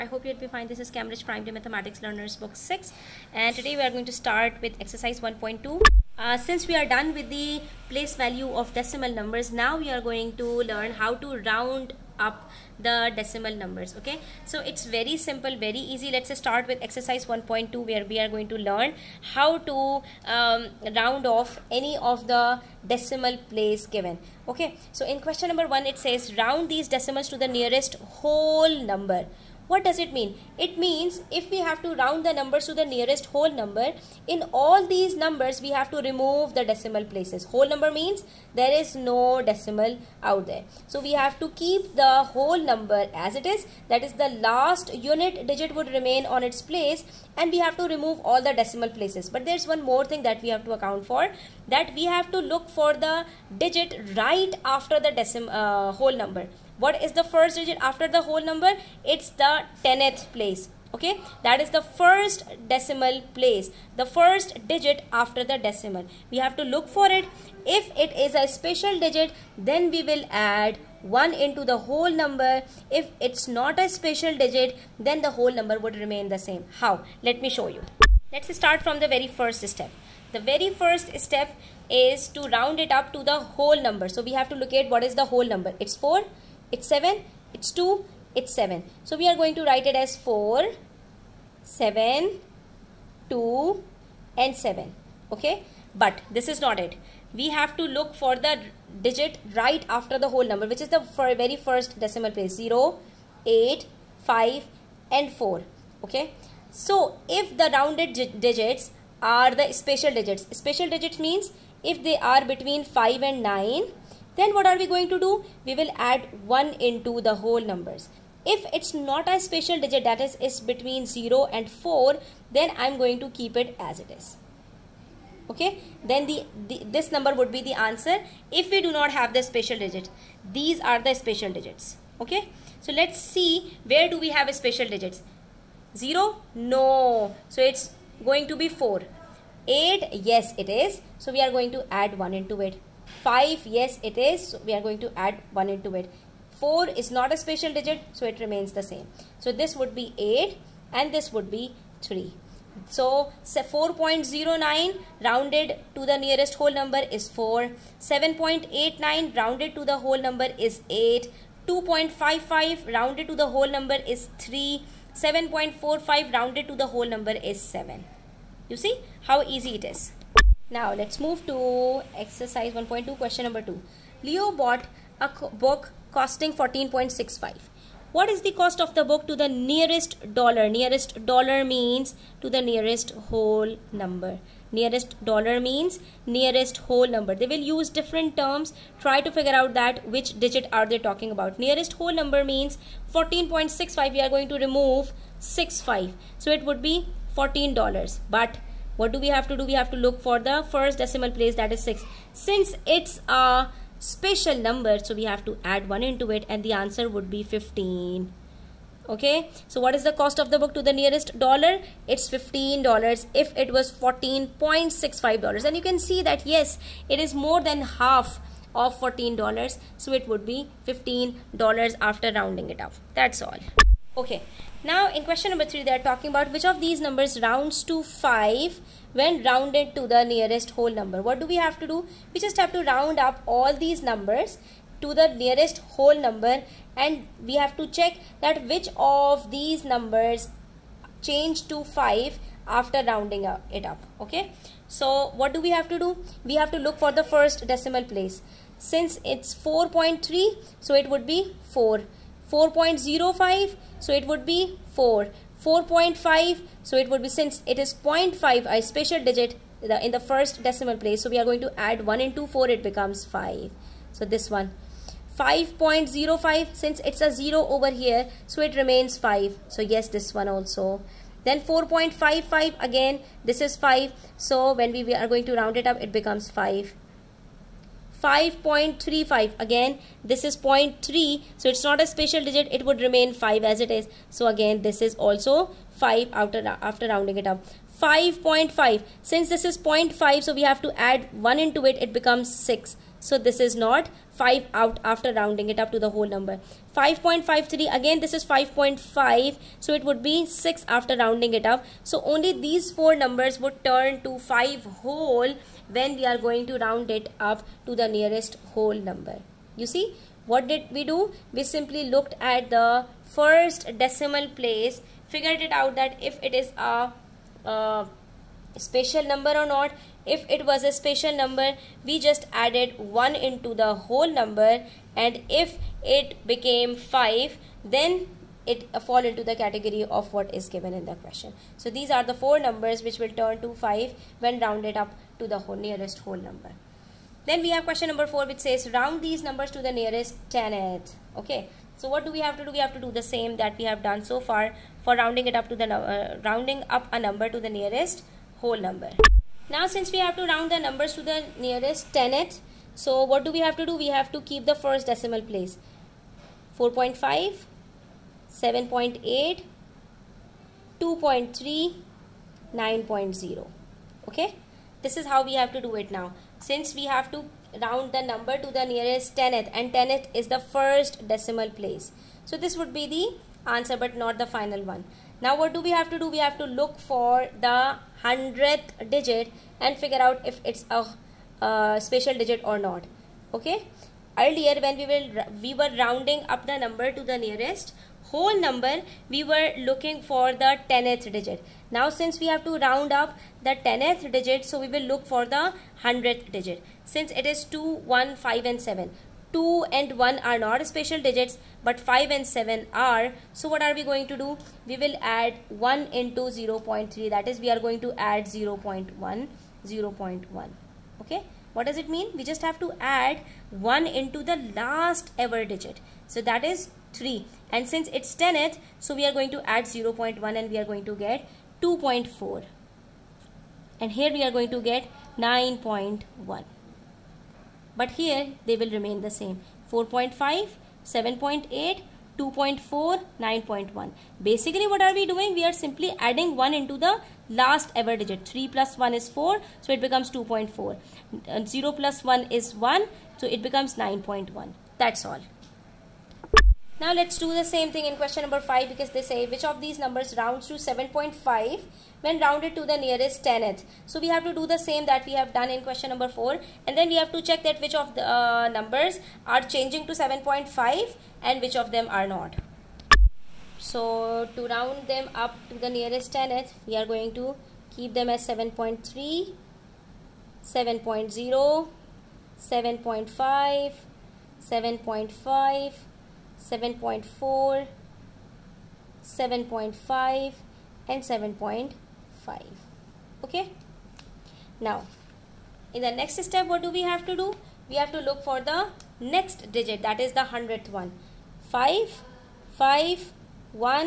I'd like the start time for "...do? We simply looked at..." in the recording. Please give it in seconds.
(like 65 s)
311 s.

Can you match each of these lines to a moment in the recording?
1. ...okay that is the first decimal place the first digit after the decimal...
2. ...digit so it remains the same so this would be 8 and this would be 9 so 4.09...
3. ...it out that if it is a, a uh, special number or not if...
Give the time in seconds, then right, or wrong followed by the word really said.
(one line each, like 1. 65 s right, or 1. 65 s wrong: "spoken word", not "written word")
1. 60 s right
2. 147 s wrong: "3", not "9"
3. 315 s right.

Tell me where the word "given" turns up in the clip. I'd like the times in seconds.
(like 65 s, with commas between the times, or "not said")
23 s, 330 s.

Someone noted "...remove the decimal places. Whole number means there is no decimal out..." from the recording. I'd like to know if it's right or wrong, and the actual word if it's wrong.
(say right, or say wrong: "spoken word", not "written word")
right.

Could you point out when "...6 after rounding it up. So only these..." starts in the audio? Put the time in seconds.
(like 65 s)
300 s.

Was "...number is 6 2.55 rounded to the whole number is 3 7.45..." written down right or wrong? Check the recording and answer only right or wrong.
wrong.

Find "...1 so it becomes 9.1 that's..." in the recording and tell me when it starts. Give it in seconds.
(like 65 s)
442 s.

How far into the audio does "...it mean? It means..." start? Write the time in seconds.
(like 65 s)
30 s.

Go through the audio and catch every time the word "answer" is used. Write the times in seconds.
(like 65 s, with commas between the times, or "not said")
127 s, 206 s, 373 s.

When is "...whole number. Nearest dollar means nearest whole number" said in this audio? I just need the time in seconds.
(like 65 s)
183 s.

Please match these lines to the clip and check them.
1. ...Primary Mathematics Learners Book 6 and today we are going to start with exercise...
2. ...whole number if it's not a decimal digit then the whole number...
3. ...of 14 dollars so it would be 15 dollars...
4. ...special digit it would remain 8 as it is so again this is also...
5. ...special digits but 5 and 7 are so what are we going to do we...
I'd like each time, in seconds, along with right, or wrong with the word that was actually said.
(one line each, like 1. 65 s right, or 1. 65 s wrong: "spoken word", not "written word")
1. 1 s right
2. 71 s wrong: "special", not "decimal"
3. 218 s right
4. 282 s wrong: "5", not "8"
5. 400 s right.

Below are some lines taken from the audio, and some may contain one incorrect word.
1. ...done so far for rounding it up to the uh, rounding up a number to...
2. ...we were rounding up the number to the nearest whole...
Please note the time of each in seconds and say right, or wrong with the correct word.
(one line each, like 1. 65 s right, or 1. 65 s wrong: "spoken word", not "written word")
1. 344 s right
2. 385 s right.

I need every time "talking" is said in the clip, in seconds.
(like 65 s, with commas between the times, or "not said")
190 s, 226 s.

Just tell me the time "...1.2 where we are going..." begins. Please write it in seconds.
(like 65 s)
17 s.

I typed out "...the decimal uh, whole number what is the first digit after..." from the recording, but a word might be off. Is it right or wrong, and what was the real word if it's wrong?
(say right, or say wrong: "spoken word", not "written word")
right.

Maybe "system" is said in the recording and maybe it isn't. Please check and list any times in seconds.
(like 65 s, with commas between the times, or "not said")
not said.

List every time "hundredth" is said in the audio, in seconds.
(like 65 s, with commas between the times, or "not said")
378 s, 490 s.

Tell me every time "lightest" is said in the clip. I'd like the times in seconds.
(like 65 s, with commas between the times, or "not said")
not said.